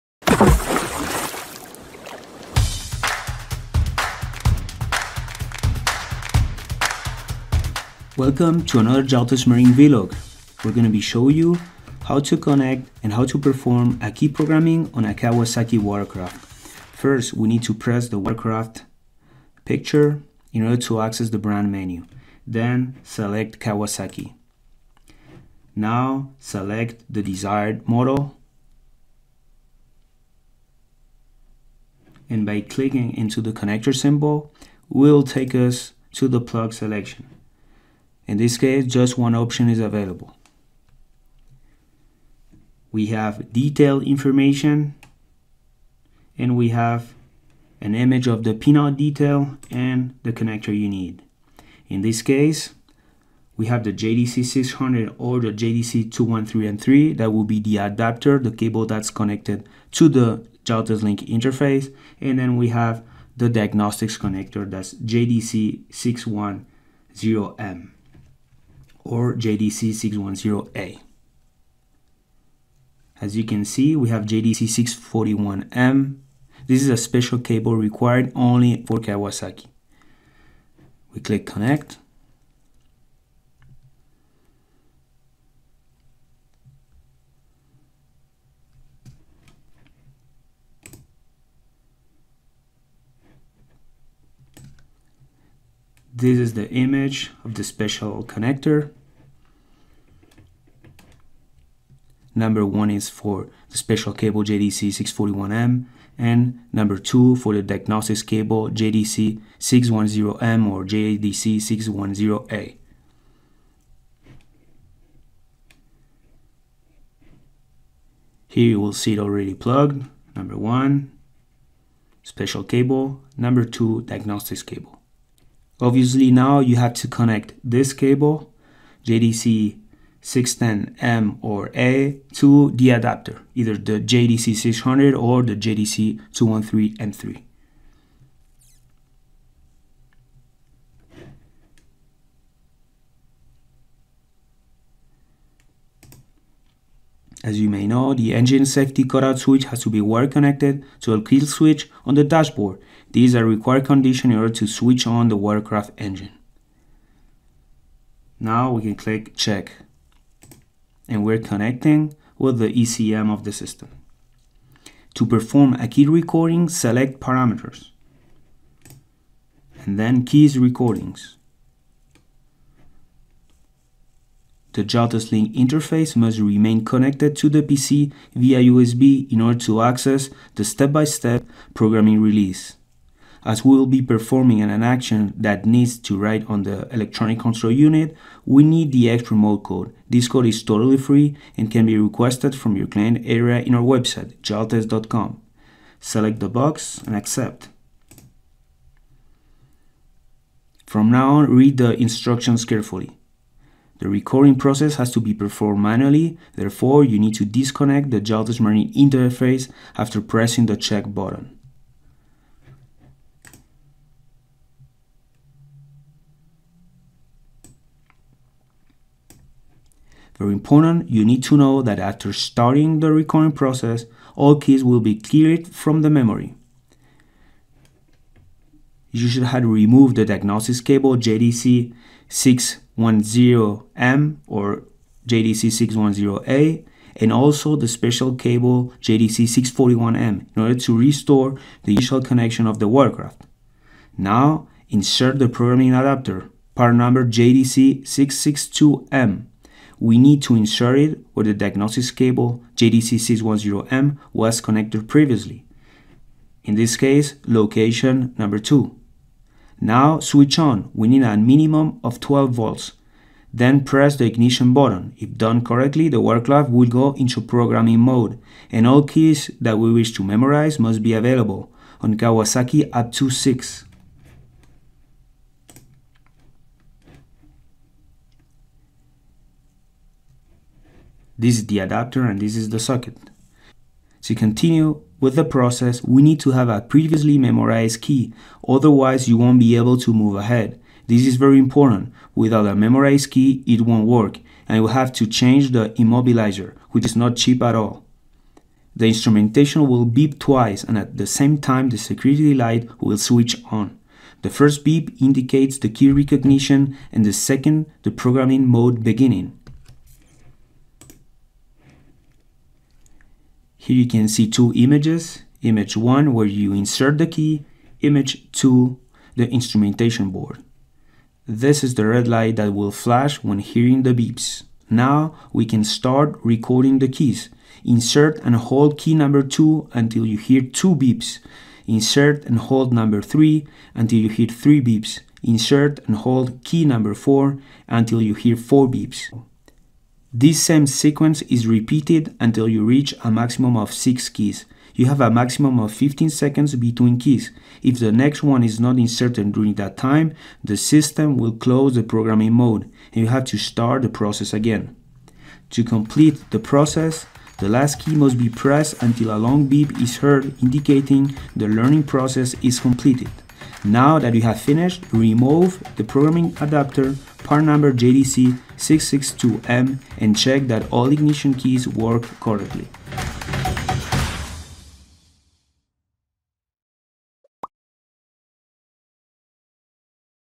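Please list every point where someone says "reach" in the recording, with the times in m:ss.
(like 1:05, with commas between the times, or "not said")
5:42.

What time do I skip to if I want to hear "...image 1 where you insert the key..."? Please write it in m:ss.
5:15.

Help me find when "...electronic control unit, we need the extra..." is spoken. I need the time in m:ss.
3:06.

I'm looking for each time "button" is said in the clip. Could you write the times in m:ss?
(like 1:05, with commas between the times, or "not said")
3:31, 4:24.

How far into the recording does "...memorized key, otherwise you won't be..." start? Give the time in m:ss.
4:47.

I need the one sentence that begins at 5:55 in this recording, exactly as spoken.
To complete the process, the last key must be pressed until a long beep is heard indicating the learning process is completed.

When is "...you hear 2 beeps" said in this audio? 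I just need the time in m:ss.
5:30.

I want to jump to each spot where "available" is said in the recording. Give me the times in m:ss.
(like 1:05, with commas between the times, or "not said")
0:39, 4:31.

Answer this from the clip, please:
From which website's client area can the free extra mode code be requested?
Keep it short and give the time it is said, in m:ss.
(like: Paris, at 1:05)
jaltest.com, at 3:14.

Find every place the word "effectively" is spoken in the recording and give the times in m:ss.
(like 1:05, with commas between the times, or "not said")
not said.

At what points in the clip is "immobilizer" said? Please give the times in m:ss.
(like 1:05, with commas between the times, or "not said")
4:55.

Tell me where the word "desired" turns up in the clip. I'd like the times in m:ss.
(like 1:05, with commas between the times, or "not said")
0:27.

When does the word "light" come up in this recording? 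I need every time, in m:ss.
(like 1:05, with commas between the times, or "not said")
5:02, 5:22.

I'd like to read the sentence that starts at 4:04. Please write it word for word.
Now insert the programming adapter, part number JDC 662M.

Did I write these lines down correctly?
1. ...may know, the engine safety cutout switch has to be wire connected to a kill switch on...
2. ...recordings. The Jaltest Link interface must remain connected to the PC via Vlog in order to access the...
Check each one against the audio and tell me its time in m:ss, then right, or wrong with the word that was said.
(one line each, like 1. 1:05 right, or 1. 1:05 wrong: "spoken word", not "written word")
1. 2:27 right
2. 2:50 wrong: "USB", not "Vlog".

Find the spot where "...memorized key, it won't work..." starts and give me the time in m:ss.
4:52.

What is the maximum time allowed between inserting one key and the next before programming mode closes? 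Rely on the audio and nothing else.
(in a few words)
15 seconds.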